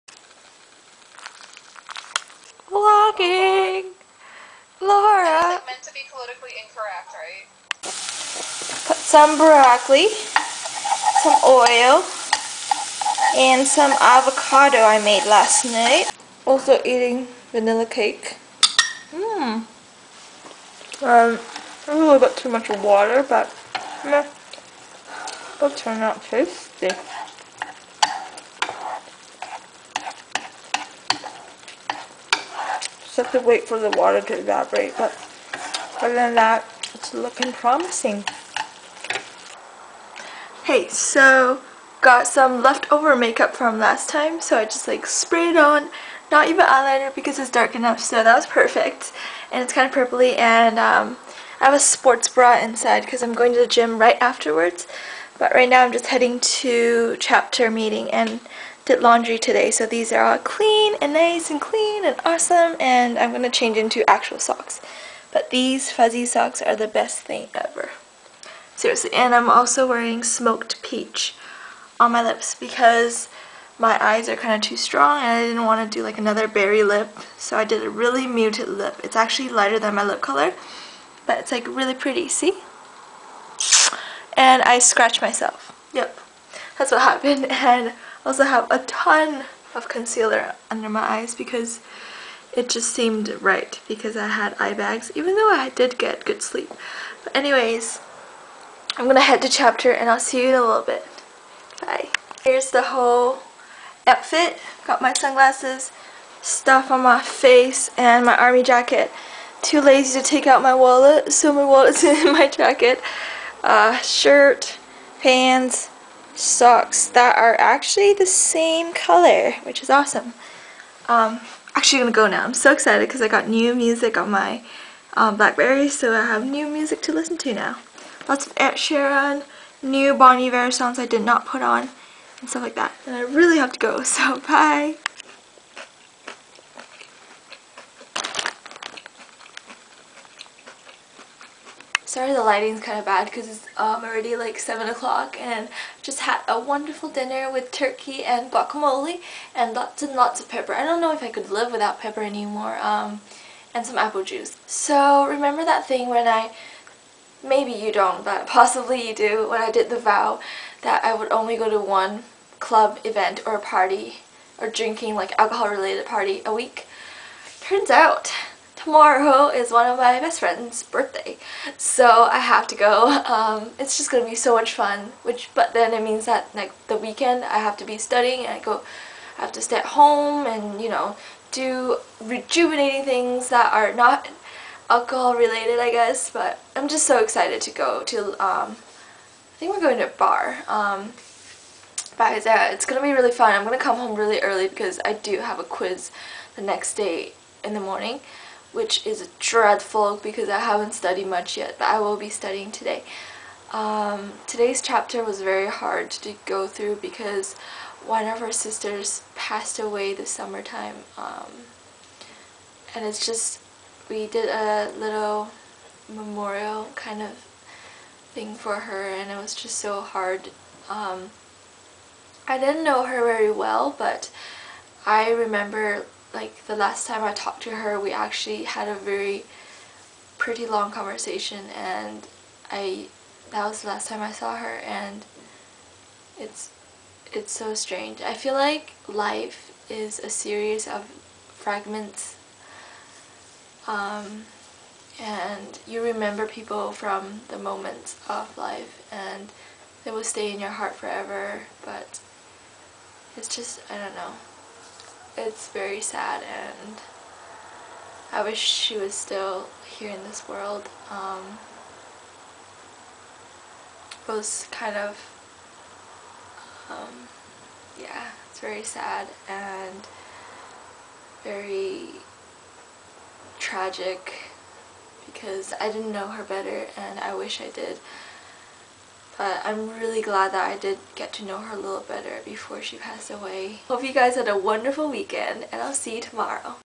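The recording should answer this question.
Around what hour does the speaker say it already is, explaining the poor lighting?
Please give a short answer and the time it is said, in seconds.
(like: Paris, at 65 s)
7 o'clock, at 144 s.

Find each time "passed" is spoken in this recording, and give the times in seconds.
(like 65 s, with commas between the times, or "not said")
209 s, 282 s.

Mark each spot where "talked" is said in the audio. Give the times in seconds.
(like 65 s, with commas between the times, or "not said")
227 s.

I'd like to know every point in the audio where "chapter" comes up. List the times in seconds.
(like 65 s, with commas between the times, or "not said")
57 s, 99 s, 204 s.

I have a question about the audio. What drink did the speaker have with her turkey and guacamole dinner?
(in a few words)
apple juice.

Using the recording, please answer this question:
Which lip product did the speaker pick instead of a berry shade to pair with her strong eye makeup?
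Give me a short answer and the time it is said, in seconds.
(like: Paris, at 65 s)
smoked peach, at 70 s.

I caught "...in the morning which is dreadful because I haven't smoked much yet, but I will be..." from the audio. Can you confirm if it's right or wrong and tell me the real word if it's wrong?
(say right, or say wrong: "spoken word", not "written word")
wrong: "studied", not "smoked".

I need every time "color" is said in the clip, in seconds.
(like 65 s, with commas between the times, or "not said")
80 s, 118 s.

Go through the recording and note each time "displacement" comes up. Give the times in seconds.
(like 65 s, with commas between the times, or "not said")
not said.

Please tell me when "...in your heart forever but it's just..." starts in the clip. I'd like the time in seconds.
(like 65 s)
250 s.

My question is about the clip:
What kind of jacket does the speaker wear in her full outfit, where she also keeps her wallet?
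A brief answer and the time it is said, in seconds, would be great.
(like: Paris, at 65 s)
army jacket, at 108 s.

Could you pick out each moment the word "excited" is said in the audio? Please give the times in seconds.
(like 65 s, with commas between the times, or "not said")
122 s, 187 s.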